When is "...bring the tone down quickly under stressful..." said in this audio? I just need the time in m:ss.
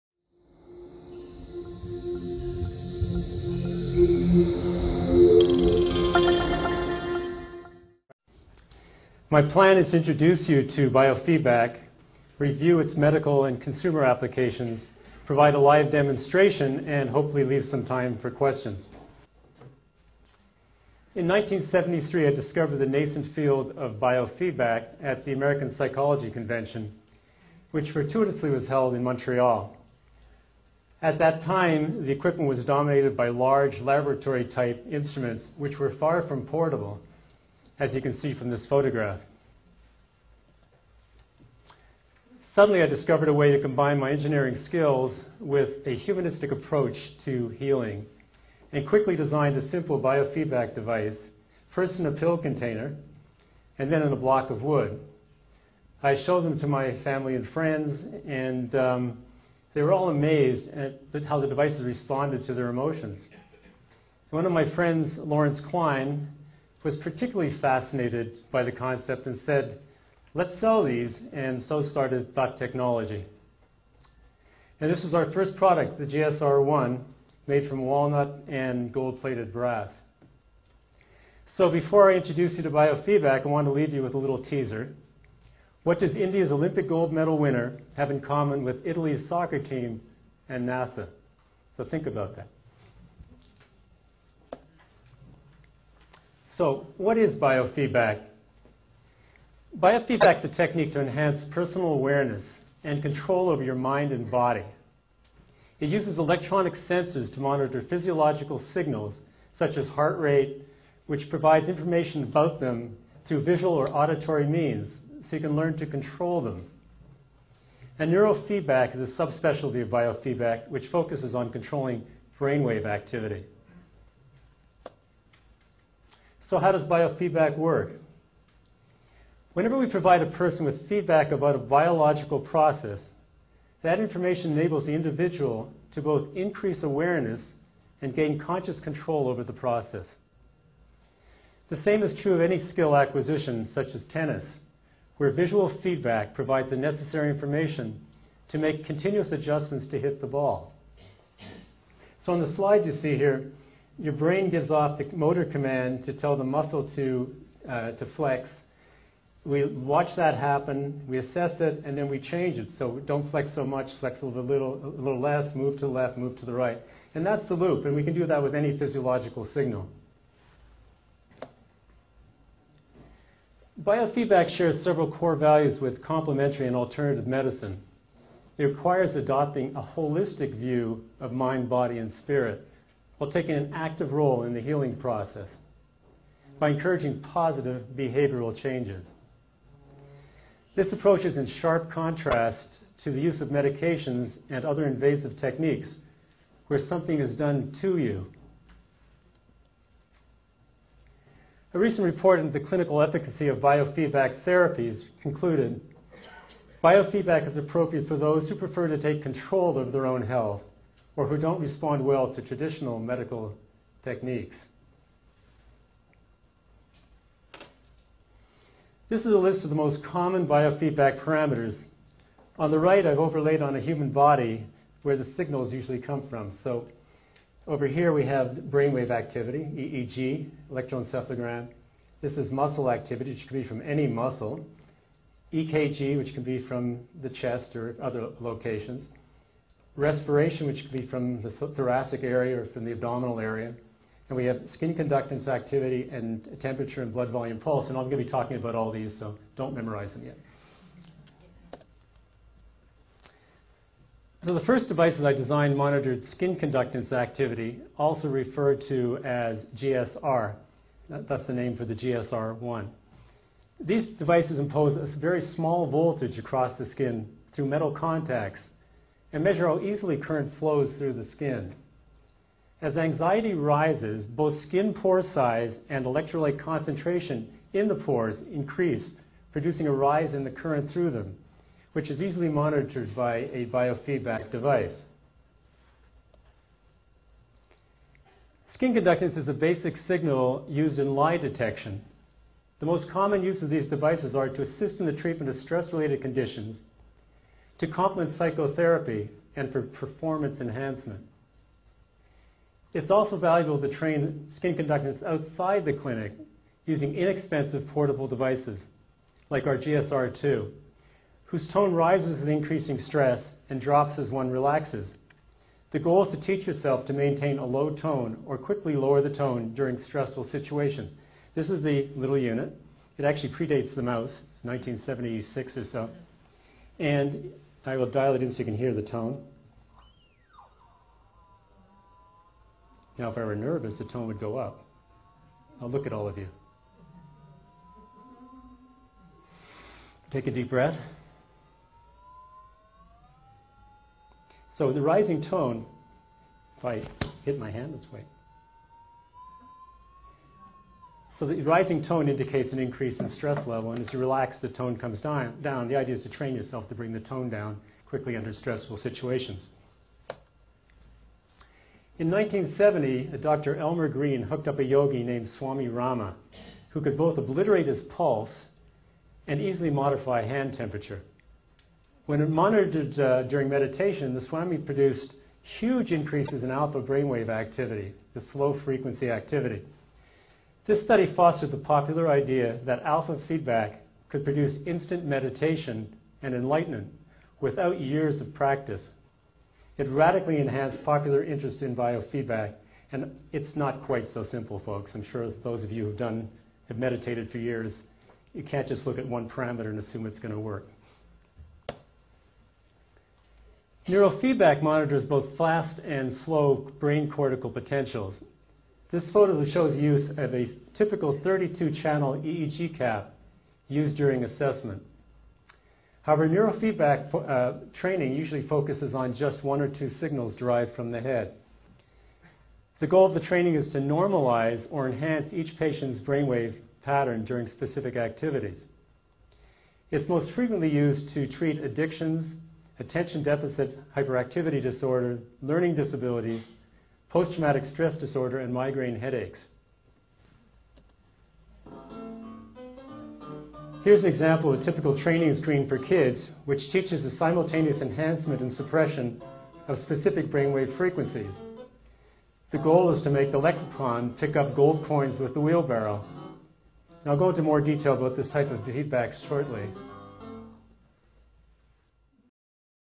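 5:56.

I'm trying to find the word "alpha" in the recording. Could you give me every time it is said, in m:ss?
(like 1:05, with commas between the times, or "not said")
6:16, 6:23.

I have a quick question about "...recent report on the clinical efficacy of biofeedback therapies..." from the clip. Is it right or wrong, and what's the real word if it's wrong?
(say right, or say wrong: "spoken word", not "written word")
right.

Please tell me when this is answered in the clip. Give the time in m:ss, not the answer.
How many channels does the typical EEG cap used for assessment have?
6:51.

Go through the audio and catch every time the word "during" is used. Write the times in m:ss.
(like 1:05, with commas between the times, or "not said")
5:19, 6:13, 6:54, 7:07.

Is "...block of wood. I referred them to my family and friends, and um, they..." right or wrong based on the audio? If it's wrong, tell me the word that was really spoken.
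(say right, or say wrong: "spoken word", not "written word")
wrong: "showed", not "referred".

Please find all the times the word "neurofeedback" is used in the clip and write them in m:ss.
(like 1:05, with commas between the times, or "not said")
1:58, 6:44, 6:56.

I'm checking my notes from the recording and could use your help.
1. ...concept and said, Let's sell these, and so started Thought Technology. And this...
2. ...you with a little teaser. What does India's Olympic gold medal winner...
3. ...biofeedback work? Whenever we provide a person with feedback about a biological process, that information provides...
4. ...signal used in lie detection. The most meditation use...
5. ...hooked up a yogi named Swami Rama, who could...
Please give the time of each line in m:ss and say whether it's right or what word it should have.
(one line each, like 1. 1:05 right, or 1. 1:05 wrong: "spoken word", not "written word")
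1. 1:08 right
2. 1:23 right
3. 2:06 wrong: "enables", not "provides"
4. 4:49 wrong: "common", not "meditation"
5. 6:04 right.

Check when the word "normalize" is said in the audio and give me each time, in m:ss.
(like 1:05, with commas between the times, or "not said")
7:03.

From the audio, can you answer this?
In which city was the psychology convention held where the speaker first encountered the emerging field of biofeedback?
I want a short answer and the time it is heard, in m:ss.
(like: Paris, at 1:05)
Montreal, at 0:29.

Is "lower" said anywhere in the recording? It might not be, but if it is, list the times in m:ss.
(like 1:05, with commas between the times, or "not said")
5:18.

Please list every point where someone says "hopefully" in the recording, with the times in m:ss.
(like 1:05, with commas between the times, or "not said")
0:17.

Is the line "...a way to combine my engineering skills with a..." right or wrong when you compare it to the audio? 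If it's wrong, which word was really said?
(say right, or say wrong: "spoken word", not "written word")
right.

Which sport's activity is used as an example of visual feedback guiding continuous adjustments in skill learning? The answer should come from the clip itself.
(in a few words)
tennis.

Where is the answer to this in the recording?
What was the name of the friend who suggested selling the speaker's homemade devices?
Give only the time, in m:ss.
1:05.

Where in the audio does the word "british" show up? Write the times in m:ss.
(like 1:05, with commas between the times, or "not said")
not said.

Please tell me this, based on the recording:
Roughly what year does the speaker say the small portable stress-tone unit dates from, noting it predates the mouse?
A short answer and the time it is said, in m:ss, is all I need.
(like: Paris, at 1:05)
1976, at 5:24.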